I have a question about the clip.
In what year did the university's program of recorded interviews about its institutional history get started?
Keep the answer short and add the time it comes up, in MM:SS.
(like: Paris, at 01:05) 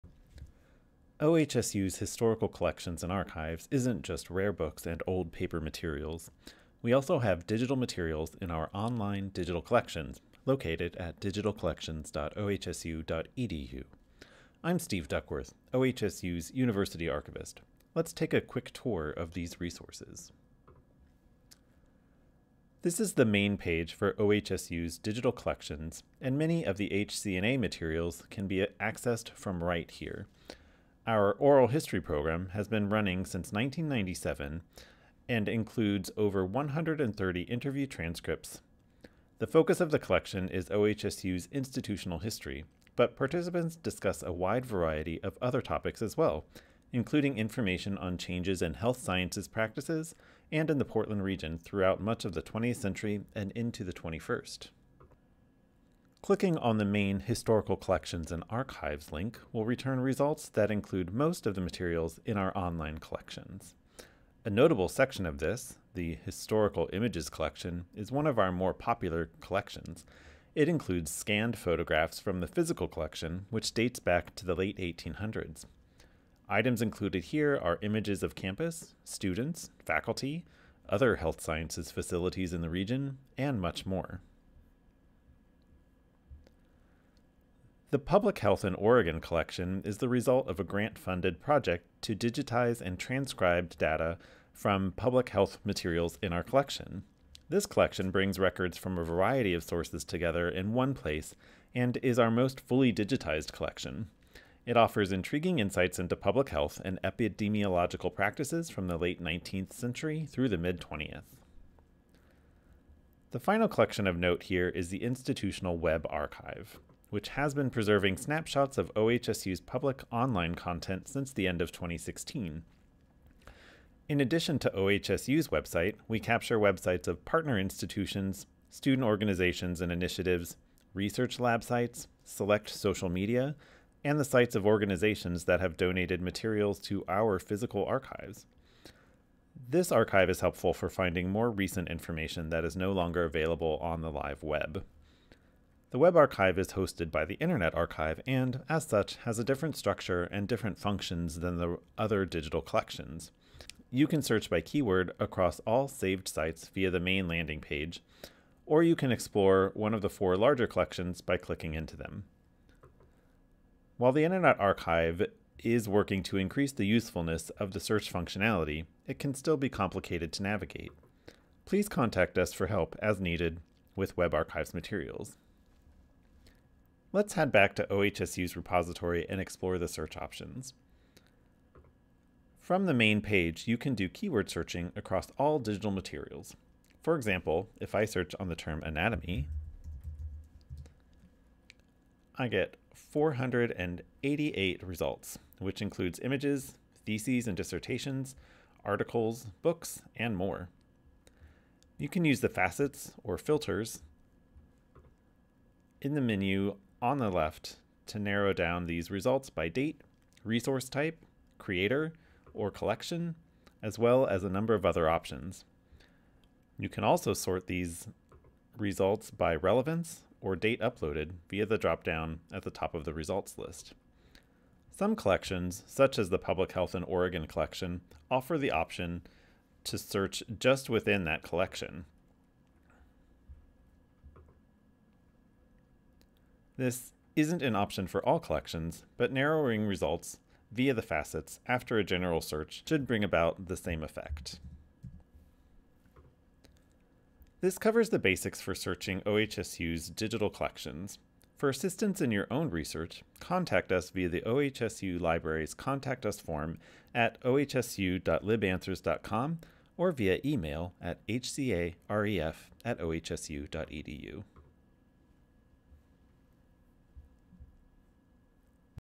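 1997, at 00:33.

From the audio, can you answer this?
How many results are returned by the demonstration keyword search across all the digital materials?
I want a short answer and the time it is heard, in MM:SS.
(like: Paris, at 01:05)
488, at 03:12.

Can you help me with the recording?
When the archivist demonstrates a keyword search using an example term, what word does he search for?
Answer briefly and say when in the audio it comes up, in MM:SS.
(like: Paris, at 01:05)
anatomy, at 03:08.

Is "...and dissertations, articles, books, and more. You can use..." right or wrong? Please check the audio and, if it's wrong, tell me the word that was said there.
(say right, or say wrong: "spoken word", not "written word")
right.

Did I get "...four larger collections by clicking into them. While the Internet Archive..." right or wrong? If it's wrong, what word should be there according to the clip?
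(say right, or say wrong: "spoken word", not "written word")
right.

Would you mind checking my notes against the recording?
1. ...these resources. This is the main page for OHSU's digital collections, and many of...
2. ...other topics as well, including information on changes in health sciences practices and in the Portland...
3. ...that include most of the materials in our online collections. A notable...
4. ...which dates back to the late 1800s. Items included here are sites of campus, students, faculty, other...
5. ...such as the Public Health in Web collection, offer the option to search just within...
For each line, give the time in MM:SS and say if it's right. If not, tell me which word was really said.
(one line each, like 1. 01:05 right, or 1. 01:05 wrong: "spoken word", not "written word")
1. 00:19 right
2. 00:45 right
3. 01:00 right
4. 01:13 wrong: "images", not "sites"
5. 03:45 wrong: "Oregon", not "Web".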